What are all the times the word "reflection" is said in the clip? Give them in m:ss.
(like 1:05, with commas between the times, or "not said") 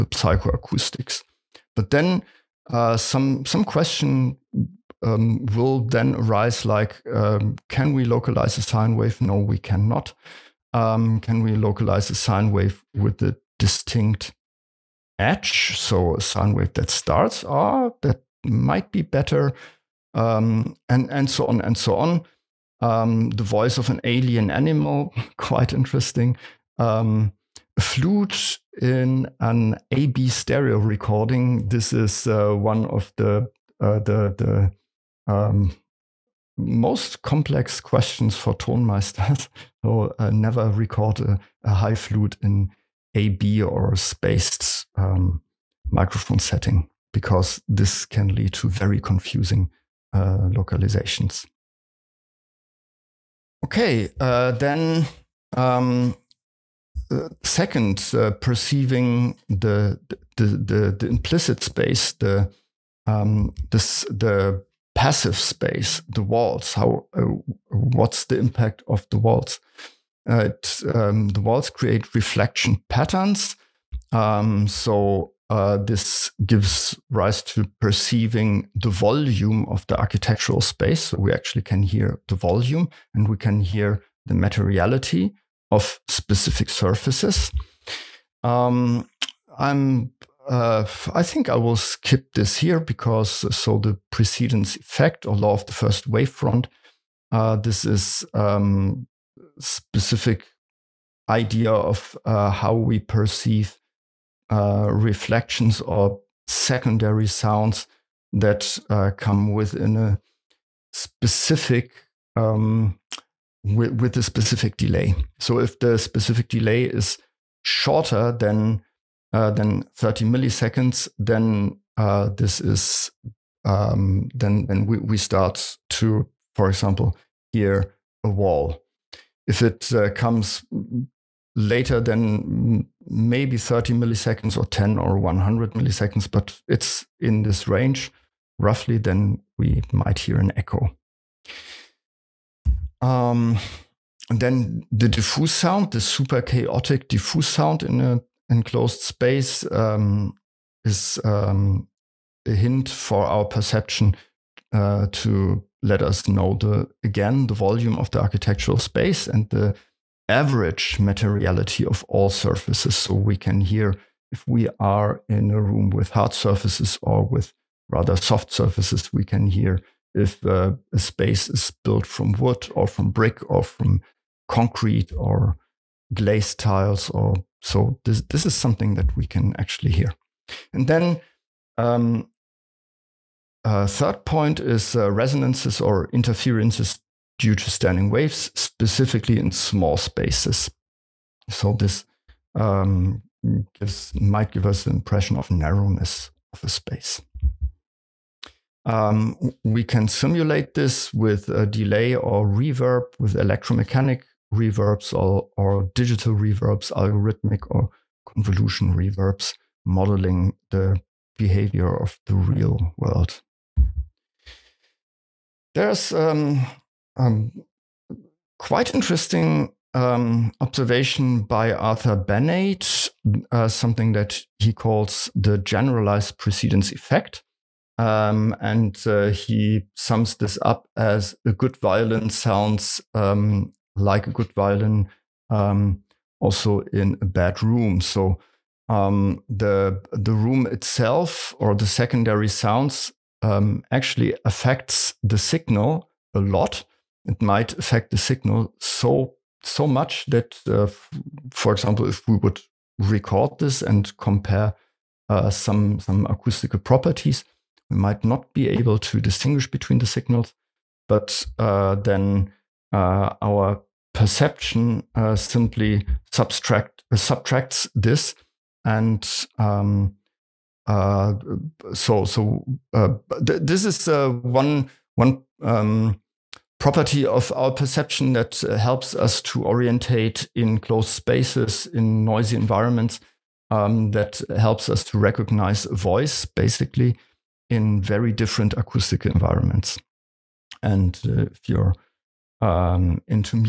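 1:12, 1:44.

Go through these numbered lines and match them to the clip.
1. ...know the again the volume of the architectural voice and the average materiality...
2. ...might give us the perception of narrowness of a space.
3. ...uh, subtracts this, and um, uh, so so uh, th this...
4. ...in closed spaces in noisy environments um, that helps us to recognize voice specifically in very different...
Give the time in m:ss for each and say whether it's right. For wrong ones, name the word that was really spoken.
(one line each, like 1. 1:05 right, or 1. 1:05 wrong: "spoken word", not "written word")
1. 2:36 wrong: "space", not "voice"
2. 3:14 wrong: "impression", not "perception"
3. 4:27 right
4. 4:40 wrong: "basically", not "specifically".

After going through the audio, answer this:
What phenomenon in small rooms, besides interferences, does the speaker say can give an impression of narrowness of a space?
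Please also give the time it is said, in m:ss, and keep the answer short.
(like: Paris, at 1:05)
standing waves, at 3:07.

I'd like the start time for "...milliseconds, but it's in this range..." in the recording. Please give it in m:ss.
2:15.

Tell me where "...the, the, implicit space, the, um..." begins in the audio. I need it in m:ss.
1:00.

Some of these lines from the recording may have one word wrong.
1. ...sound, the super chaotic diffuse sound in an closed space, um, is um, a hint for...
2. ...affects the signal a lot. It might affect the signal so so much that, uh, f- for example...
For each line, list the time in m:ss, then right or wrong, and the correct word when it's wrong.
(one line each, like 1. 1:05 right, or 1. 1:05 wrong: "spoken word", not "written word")
1. 2:25 wrong: "enclosed", not "closed"
2. 4:04 right.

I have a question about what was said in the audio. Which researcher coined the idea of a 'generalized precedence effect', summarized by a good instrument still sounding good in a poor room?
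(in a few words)
Arthur Benade.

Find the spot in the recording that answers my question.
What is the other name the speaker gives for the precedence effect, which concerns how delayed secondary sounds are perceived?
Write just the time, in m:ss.
1:35.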